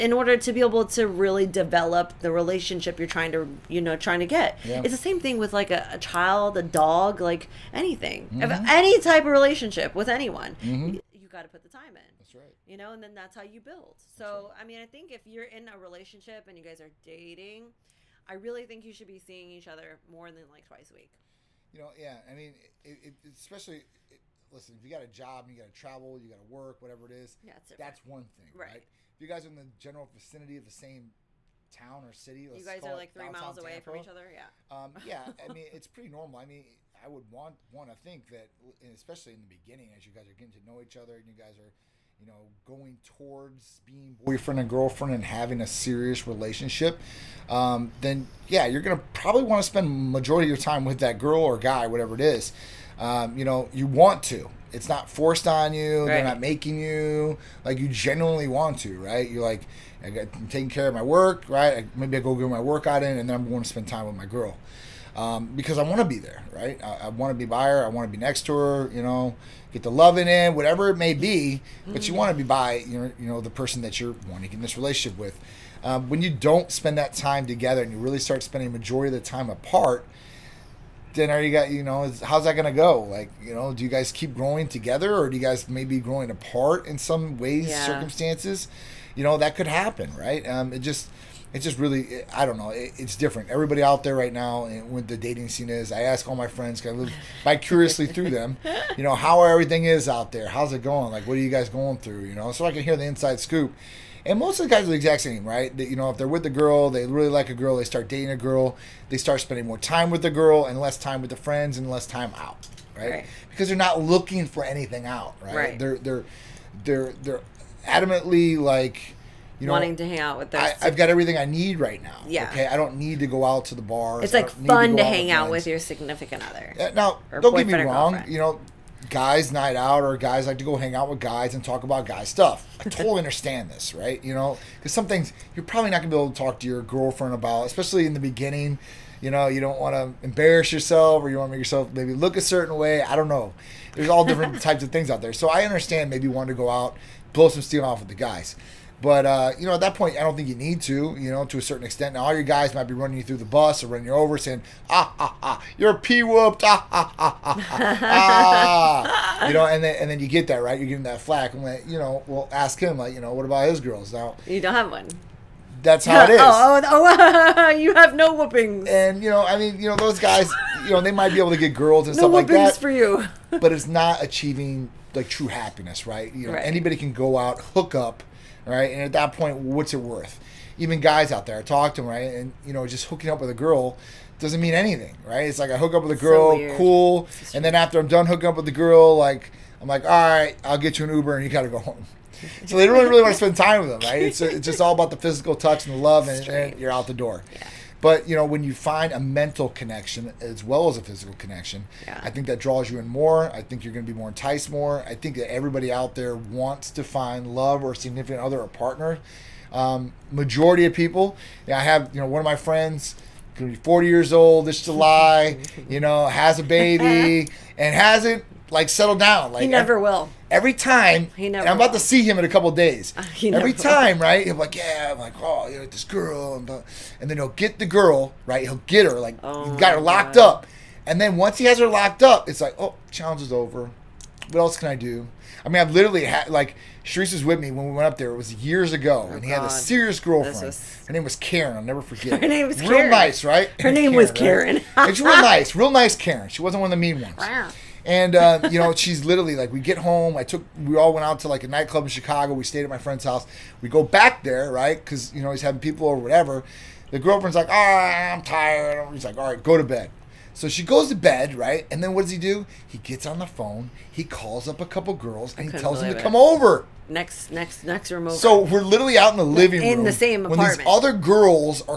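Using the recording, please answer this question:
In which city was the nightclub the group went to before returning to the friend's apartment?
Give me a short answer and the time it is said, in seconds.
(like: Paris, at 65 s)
Chicago, at 252 s.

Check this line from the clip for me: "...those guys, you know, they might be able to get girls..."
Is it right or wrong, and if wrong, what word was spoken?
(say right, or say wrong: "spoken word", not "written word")
right.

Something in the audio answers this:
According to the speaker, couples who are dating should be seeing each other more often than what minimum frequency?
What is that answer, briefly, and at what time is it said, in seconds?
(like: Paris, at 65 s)
twice a week, at 20 s.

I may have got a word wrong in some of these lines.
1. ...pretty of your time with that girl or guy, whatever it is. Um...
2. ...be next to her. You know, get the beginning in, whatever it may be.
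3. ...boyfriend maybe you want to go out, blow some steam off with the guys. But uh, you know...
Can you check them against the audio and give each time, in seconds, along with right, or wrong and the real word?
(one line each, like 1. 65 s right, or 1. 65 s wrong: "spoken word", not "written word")
1. 50 s wrong: "majority", not "pretty"
2. 68 s wrong: "loving", not "beginning"
3. 145 s wrong: "understand", not "boyfriend".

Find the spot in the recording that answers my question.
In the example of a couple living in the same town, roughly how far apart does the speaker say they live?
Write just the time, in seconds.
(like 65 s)
33 s.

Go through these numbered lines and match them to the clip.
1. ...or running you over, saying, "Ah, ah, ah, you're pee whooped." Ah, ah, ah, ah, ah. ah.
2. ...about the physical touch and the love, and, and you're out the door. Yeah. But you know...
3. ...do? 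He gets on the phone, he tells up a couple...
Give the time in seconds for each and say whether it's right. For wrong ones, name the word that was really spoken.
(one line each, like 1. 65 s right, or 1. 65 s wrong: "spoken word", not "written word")
1. 153 s right
2. 194 s right
3. 262 s wrong: "calls", not "tells".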